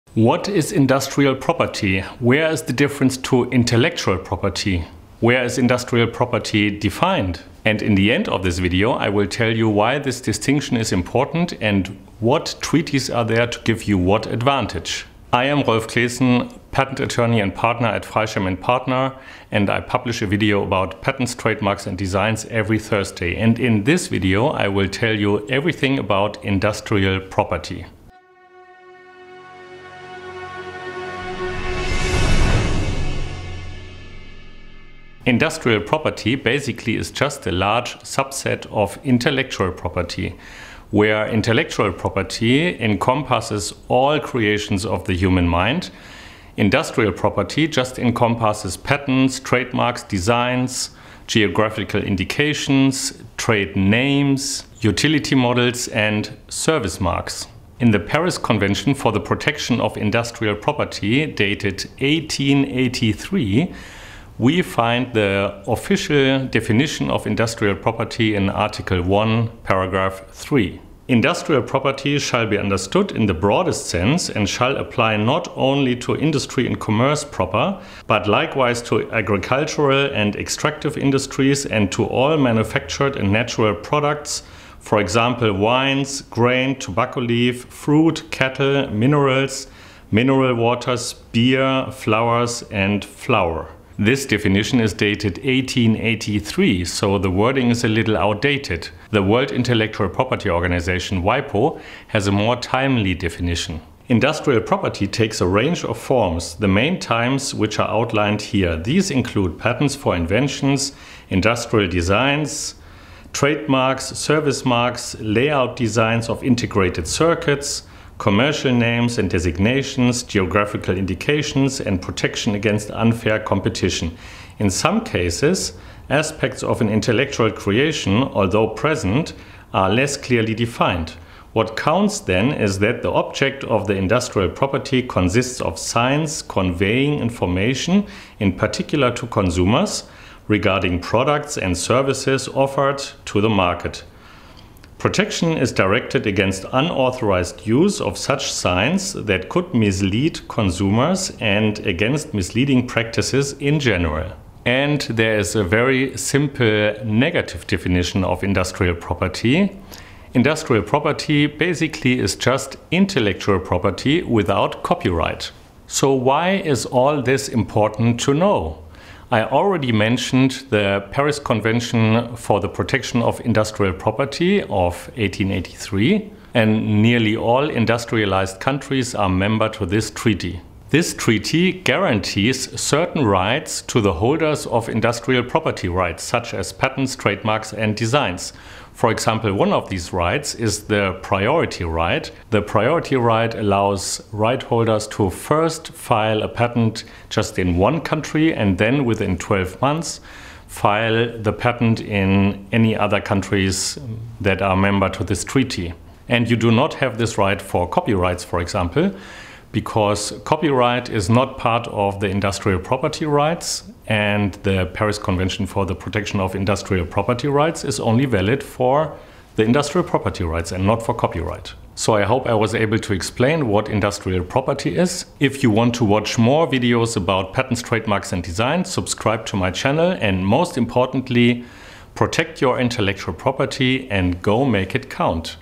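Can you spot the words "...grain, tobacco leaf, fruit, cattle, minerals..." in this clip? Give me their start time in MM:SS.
01:26.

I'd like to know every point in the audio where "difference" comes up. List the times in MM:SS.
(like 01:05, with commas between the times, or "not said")
00:02.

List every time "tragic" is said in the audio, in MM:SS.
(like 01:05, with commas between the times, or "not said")
not said.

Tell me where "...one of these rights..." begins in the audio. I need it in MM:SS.
03:09.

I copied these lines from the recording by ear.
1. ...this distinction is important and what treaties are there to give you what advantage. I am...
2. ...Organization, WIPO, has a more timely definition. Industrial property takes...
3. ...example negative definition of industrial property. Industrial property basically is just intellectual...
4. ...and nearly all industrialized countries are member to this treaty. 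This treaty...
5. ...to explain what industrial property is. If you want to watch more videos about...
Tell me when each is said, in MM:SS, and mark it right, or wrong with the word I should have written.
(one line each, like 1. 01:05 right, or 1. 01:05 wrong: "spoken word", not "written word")
1. 00:09 right
2. 01:40 right
3. 02:36 wrong: "simple", not "example"
4. 02:56 right
5. 03:42 right.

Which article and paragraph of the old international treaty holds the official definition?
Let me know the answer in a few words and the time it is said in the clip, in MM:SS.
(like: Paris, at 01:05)
Article 1, paragraph 3, at 01:08.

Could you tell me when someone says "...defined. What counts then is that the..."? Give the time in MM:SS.
02:10.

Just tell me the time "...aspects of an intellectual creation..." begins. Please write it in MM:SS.
02:06.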